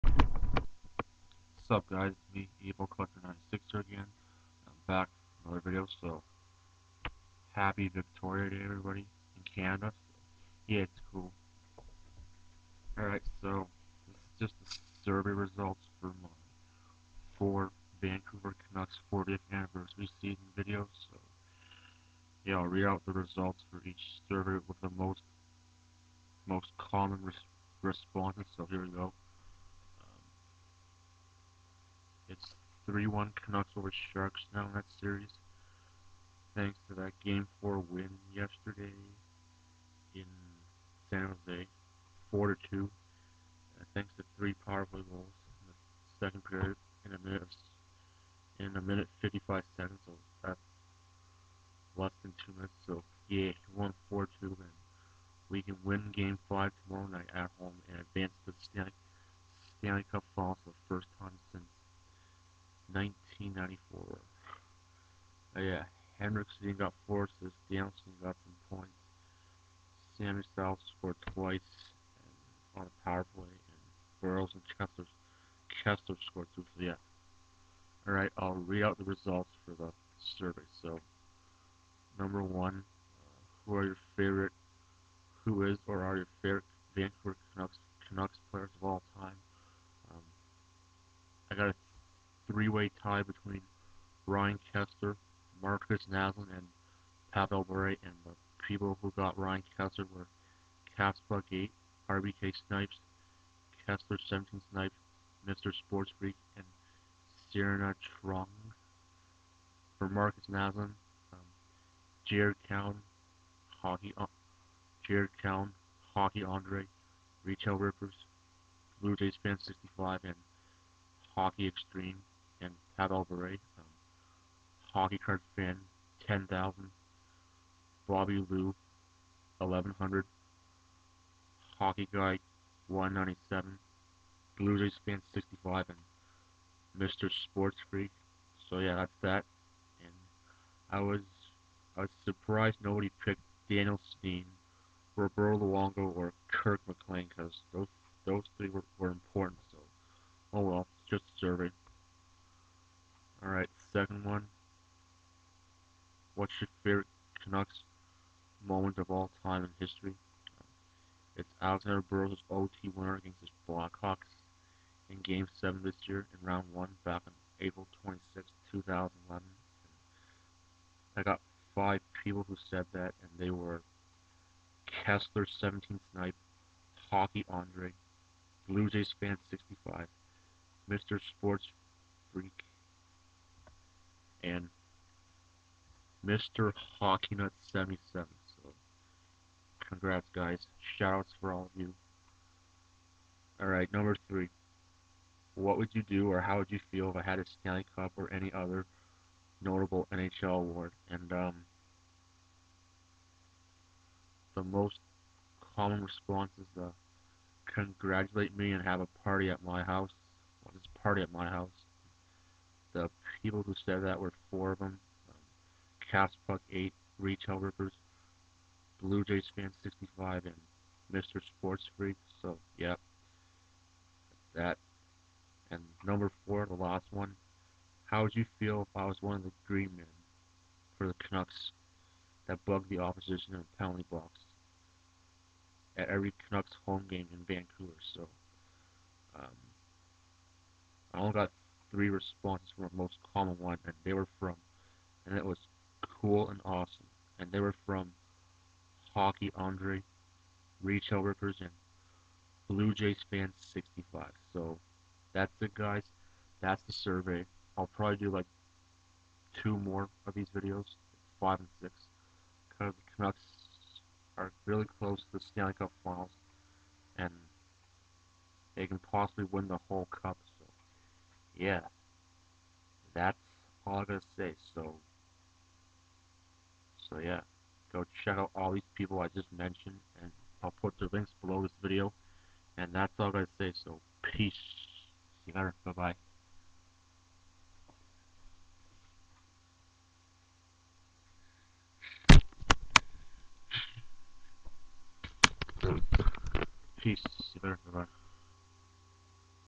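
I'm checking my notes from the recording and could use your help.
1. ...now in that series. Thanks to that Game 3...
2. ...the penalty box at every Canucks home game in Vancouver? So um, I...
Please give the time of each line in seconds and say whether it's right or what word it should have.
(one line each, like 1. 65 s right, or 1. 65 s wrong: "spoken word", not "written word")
1. 34 s wrong: "4", not "3"
2. 233 s right.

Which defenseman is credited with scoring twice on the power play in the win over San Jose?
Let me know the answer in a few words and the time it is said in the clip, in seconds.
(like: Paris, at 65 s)
Sami Salo, at 70 s.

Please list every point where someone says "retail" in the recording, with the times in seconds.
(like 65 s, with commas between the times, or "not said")
117 s, 217 s, 250 s.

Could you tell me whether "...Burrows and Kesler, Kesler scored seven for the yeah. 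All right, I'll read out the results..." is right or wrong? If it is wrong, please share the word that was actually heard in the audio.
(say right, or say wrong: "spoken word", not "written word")
wrong: "two", not "seven".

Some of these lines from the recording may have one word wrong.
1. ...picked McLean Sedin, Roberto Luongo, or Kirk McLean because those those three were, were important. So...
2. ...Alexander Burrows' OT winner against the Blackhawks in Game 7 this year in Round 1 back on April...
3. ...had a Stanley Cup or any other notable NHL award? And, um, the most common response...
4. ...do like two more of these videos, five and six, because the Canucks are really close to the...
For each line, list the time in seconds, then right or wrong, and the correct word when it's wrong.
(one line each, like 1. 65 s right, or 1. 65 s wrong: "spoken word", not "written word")
1. 143 s wrong: "Daniel", not "McLean"
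2. 161 s right
3. 197 s right
4. 258 s right.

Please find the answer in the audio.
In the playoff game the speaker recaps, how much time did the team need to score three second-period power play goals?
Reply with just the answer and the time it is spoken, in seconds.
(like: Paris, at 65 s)
1 minute 55 seconds, at 48 s.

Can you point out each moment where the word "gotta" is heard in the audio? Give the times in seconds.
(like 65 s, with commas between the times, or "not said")
274 s, 283 s.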